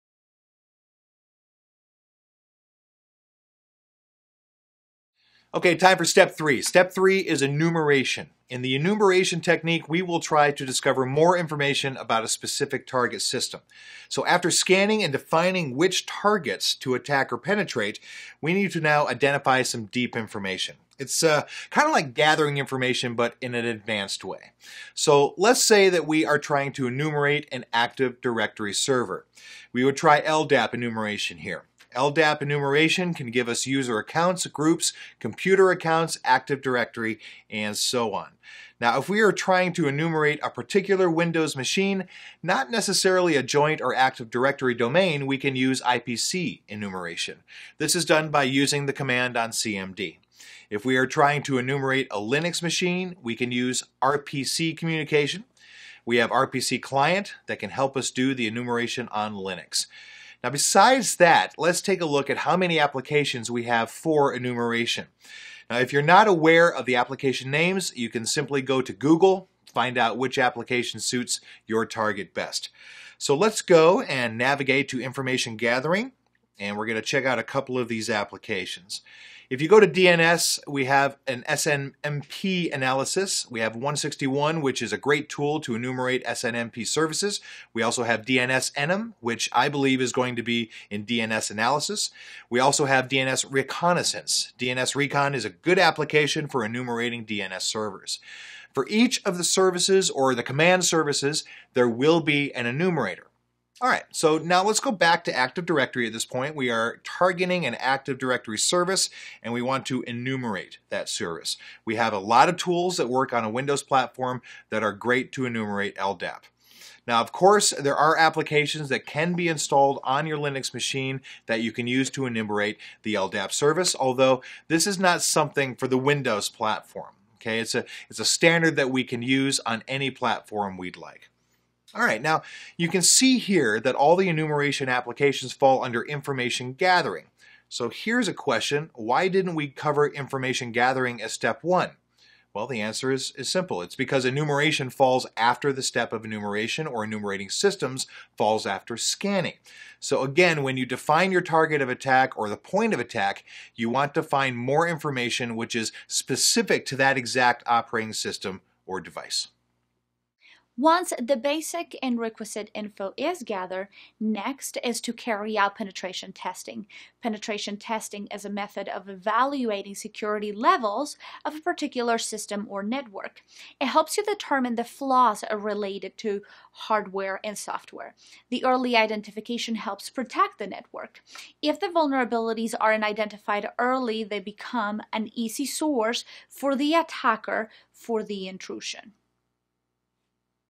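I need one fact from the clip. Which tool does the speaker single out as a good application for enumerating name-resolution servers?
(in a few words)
DNS Recon.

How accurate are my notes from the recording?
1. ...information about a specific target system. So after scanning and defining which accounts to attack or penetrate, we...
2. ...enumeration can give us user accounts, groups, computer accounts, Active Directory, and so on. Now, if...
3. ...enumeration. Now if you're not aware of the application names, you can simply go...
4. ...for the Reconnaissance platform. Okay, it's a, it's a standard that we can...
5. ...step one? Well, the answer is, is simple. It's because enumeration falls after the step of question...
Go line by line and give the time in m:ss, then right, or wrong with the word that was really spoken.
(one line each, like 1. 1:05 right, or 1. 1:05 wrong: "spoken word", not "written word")
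1. 0:11 wrong: "targets", not "accounts"
2. 0:32 right
3. 1:04 right
4. 2:05 wrong: "Windows", not "Reconnaissance"
5. 2:21 wrong: "enumeration", not "question".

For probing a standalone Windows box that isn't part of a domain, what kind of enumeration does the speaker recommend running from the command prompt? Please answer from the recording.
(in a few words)
IPC enumeration.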